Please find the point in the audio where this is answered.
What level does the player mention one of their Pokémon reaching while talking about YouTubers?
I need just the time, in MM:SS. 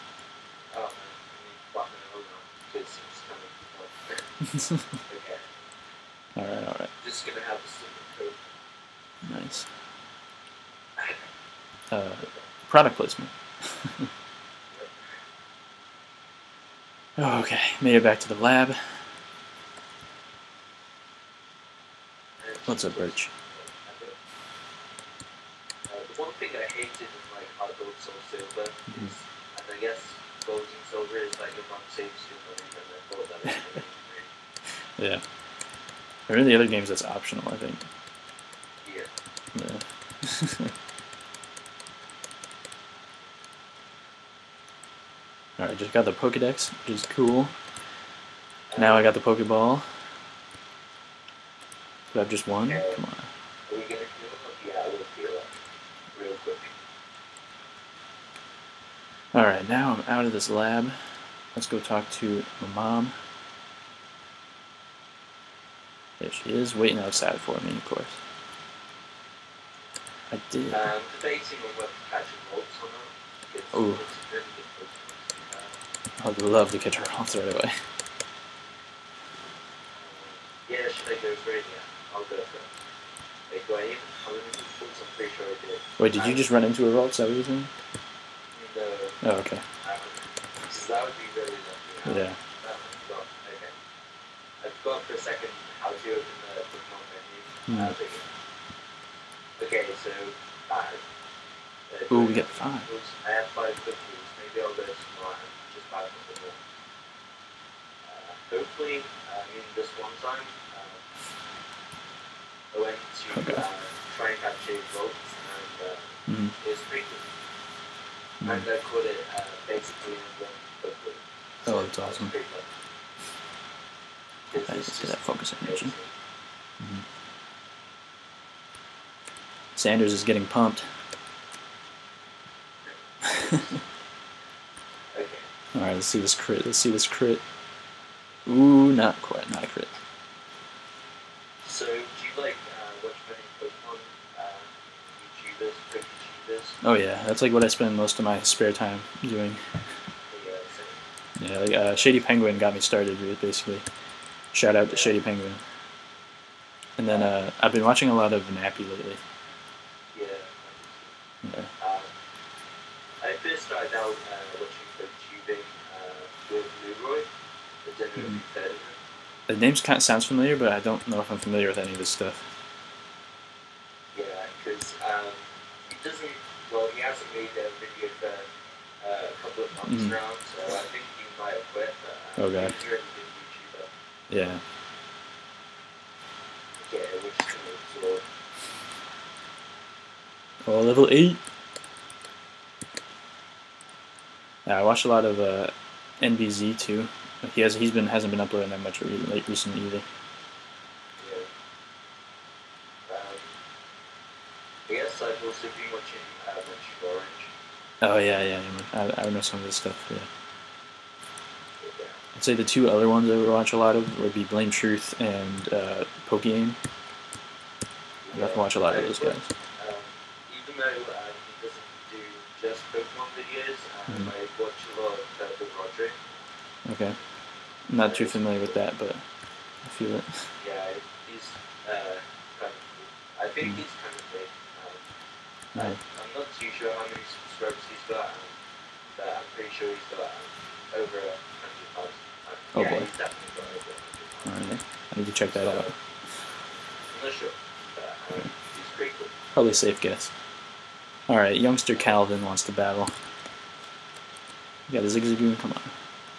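03:10.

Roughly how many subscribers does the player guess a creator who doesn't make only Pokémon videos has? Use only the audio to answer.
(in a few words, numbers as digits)
over 100,000.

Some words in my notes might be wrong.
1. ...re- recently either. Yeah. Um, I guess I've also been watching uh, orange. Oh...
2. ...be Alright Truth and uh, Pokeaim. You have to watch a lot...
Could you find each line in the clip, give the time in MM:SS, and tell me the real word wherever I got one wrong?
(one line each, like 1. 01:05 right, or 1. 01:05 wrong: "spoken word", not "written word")
1. 03:19 right
2. 03:34 wrong: "Blame", not "Alright".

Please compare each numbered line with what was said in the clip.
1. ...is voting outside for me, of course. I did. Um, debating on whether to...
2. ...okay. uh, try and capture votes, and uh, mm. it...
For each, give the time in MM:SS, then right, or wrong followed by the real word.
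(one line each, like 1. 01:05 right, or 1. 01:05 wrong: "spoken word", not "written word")
1. 01:06 wrong: "waiting", not "voting"
2. 01:53 right.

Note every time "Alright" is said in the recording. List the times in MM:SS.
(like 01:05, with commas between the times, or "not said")
00:45, 00:59, 04:04, 04:11.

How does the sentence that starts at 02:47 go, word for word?
The, mm the name's kind of sounds familiar, but I don't know if I'm familiar with any of this stuff.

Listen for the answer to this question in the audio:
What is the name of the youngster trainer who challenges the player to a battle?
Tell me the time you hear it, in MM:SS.
04:11.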